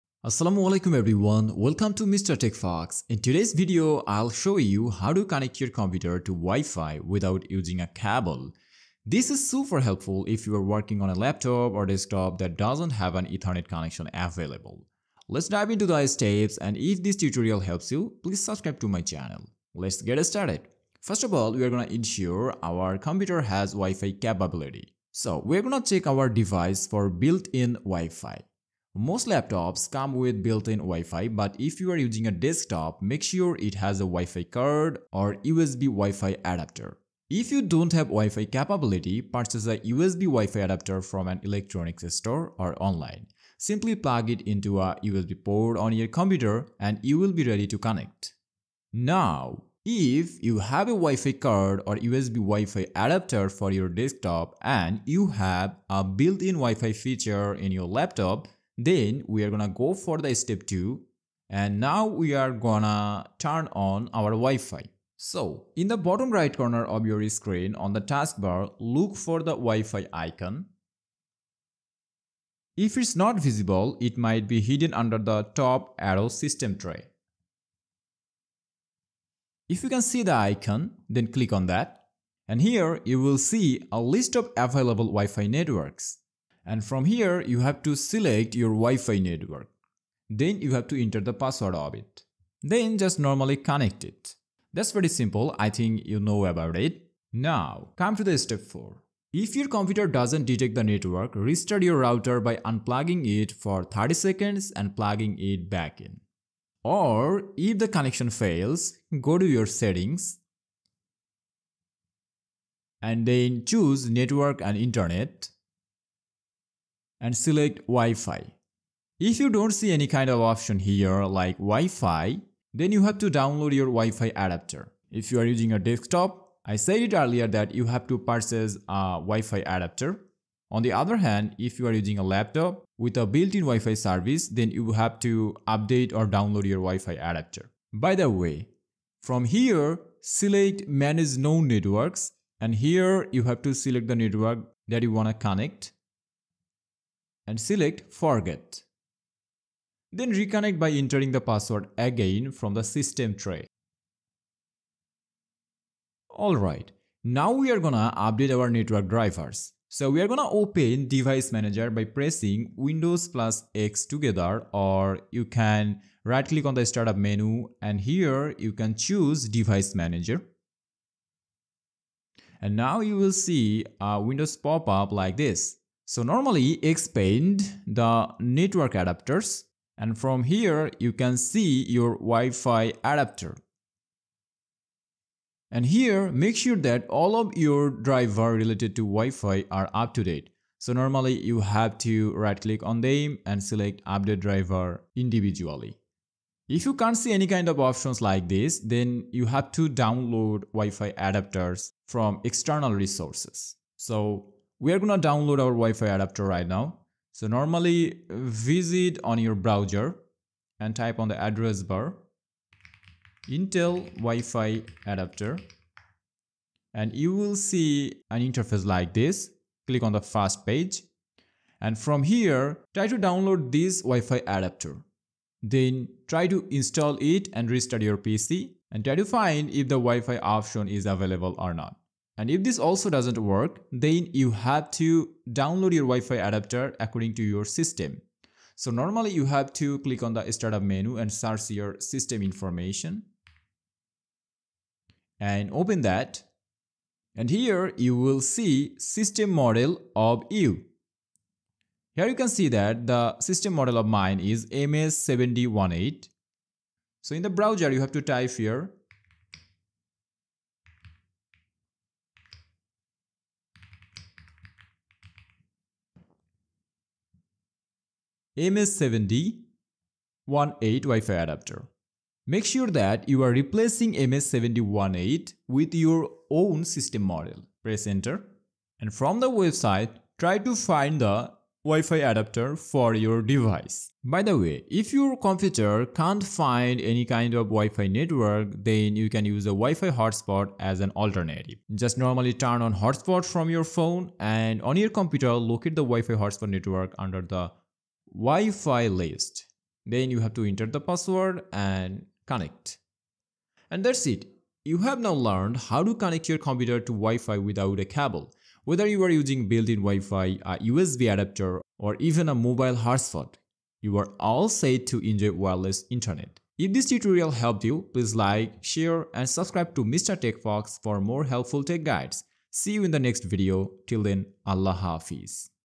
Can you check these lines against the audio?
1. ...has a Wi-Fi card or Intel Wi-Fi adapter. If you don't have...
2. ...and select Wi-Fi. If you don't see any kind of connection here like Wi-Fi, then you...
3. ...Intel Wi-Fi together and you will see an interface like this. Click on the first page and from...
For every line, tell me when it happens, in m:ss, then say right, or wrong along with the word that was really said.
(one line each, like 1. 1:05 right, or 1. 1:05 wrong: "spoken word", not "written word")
1. 0:33 wrong: "USB", not "Intel"
2. 1:57 wrong: "option", not "connection"
3. 3:33 wrong: "adapter", not "together".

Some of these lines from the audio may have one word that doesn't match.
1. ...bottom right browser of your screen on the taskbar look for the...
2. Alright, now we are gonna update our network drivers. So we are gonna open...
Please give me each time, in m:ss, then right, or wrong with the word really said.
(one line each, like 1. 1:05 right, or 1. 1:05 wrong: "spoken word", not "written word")
1. 1:05 wrong: "corner", not "browser"
2. 2:36 right.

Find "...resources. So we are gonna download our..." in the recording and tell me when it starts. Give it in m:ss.
3:22.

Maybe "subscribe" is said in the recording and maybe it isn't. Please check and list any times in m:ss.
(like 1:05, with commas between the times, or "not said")
0:18, 5:19.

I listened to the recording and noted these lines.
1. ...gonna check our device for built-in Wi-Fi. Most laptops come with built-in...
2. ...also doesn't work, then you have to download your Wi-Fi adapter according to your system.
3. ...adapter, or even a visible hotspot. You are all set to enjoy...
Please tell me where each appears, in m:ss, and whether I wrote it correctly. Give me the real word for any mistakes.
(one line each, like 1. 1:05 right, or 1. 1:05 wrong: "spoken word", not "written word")
1. 0:25 right
2. 3:52 right
3. 5:11 wrong: "mobile", not "visible".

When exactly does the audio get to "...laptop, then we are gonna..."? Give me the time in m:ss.
0:57.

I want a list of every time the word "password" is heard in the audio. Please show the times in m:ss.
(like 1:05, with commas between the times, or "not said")
1:31, 2:31, 5:01.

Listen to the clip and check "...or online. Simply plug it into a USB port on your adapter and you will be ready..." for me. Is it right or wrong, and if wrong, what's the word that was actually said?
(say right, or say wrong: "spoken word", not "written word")
wrong: "computer", not "adapter".